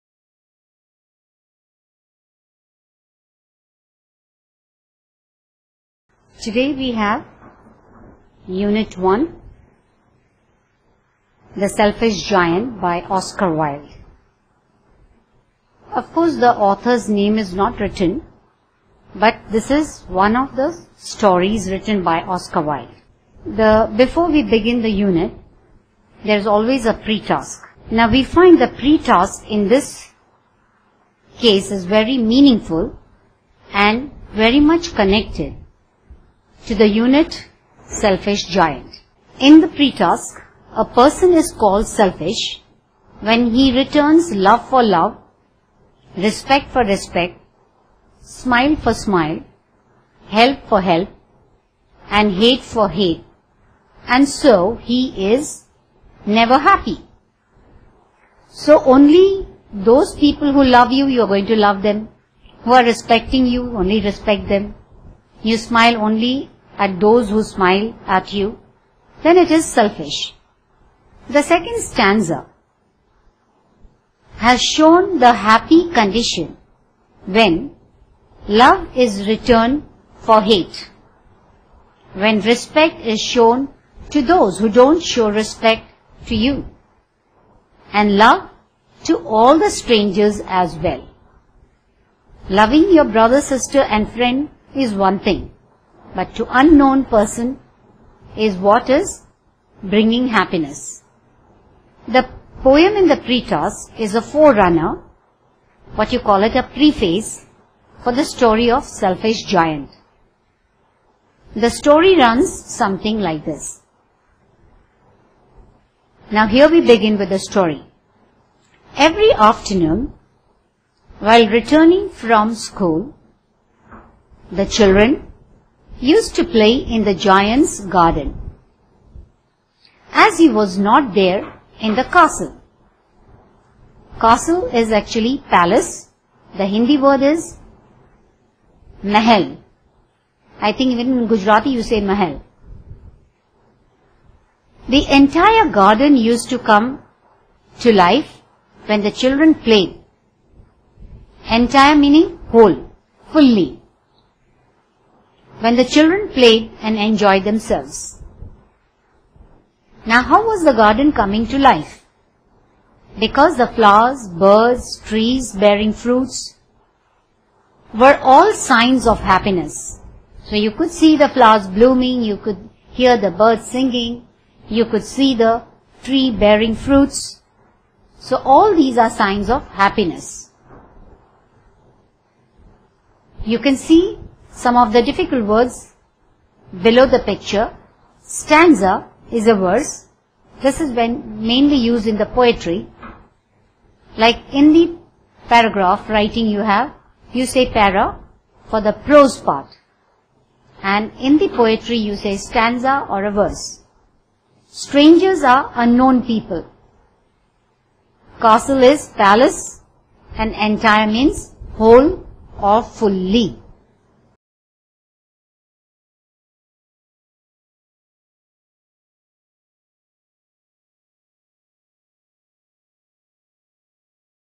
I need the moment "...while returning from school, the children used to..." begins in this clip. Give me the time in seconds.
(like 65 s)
121 s.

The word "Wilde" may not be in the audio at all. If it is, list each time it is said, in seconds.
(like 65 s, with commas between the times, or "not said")
13 s, 22 s.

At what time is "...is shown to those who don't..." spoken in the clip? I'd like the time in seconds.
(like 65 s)
83 s.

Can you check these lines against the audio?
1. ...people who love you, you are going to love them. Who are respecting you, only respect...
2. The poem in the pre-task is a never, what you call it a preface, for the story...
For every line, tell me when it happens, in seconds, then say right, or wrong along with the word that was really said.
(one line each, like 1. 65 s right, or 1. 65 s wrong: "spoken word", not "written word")
1. 60 s right
2. 102 s wrong: "forerunner", not "never".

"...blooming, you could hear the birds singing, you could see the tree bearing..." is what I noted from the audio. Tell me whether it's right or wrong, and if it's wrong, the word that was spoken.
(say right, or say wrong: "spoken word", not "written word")
right.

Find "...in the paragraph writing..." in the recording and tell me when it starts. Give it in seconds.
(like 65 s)
194 s.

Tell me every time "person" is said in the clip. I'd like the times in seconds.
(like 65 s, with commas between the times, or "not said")
40 s, 97 s.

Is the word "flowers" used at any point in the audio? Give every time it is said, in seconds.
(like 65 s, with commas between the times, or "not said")
163 s, 171 s.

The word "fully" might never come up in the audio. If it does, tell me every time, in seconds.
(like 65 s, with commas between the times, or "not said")
153 s, 212 s.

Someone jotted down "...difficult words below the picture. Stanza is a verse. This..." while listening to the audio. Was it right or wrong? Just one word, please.
right.